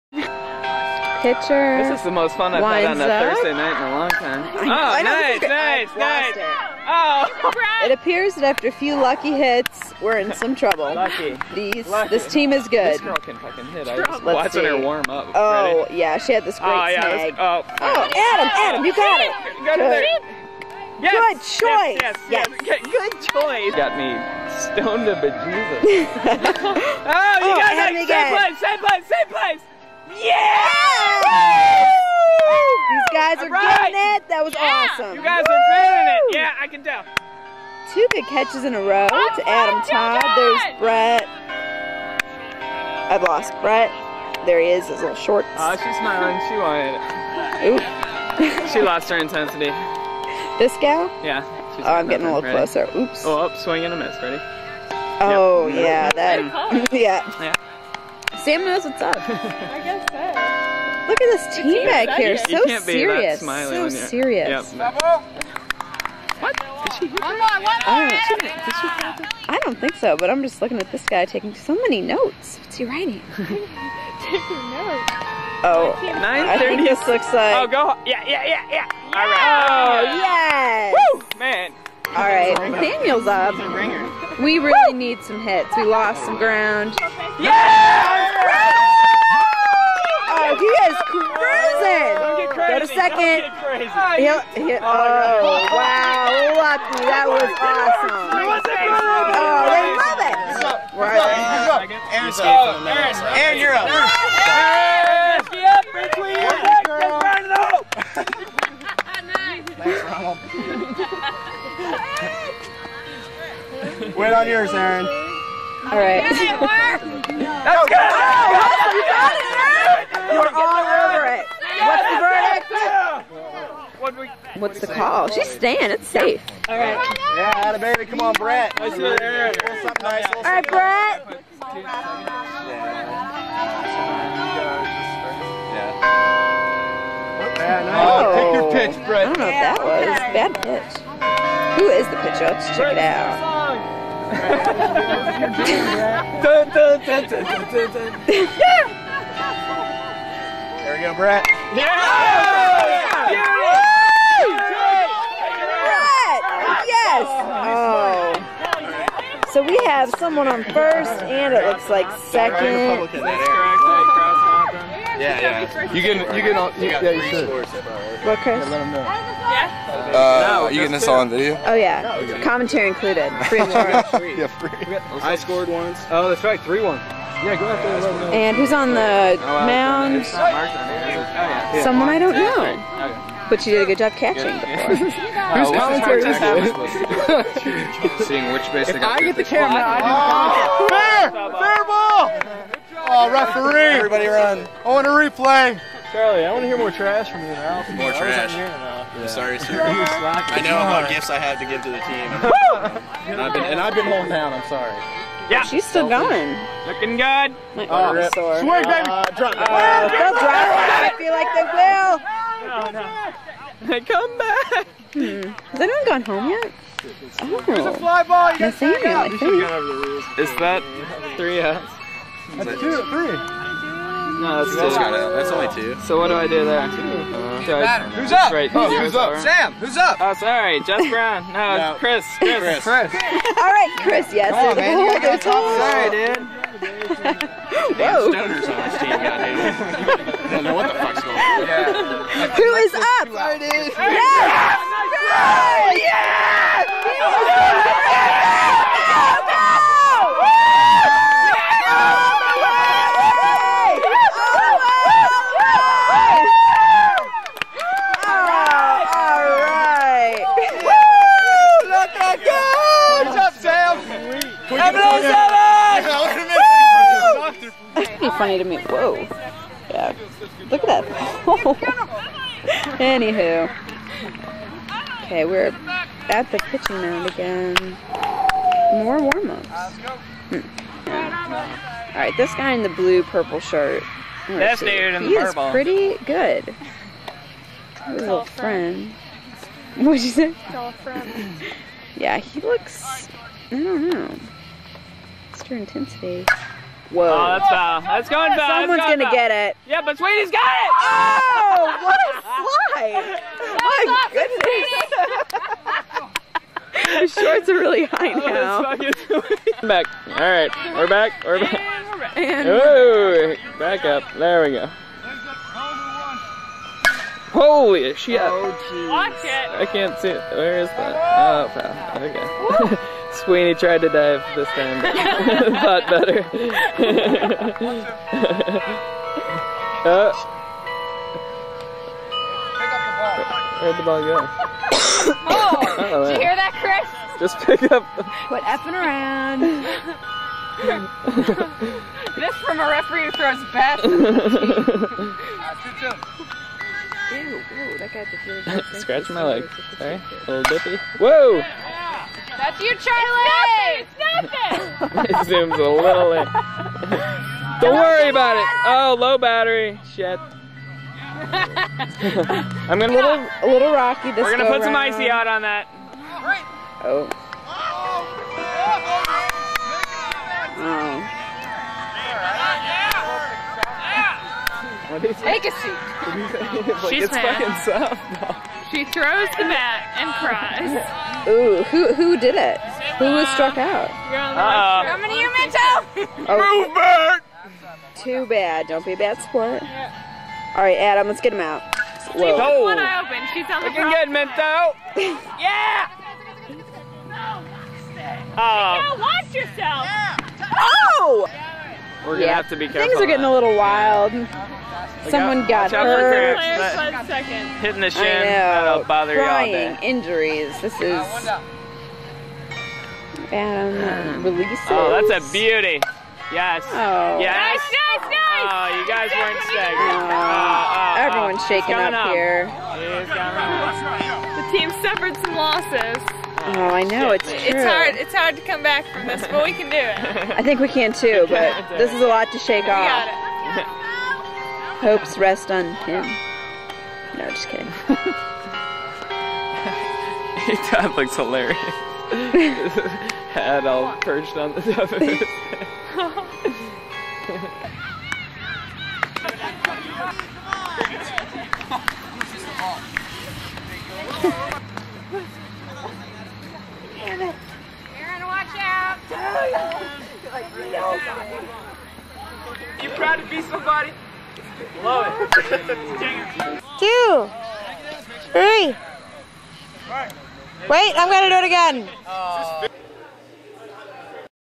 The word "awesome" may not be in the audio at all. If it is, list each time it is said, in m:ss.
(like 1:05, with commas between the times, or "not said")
0:34, 1:37.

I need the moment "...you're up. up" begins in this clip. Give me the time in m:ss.
1:43.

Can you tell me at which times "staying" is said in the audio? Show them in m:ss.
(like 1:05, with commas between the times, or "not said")
2:05.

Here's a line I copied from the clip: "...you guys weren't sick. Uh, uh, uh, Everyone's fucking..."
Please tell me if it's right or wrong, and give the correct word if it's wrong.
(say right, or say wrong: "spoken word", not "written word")
wrong: "shaking", not "fucking".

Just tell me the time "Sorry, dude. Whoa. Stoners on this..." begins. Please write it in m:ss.
3:57.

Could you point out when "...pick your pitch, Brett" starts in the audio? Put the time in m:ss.
2:18.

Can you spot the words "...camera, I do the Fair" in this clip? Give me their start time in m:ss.
3:09.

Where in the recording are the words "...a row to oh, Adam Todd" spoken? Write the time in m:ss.
0:38.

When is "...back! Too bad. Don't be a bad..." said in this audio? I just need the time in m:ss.
6:26.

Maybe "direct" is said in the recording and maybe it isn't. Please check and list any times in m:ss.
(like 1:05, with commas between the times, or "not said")
not said.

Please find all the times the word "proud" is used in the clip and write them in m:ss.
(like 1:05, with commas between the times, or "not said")
7:43.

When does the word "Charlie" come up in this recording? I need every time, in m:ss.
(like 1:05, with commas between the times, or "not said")
3:16, 5:52.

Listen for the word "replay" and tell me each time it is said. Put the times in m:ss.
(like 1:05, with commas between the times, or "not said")
3:15.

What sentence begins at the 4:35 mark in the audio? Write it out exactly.
Okay, we're at the pitching mound again.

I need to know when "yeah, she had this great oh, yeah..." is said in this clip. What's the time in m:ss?
0:15.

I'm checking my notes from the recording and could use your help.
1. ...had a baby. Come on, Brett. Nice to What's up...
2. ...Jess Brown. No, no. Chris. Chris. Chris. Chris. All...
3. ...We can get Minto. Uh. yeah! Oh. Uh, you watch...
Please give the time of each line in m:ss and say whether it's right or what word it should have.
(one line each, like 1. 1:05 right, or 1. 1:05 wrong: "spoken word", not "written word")
1. 2:07 right
2. 3:50 right
3. 6:33 right.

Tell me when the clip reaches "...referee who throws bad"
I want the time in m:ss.
5:42.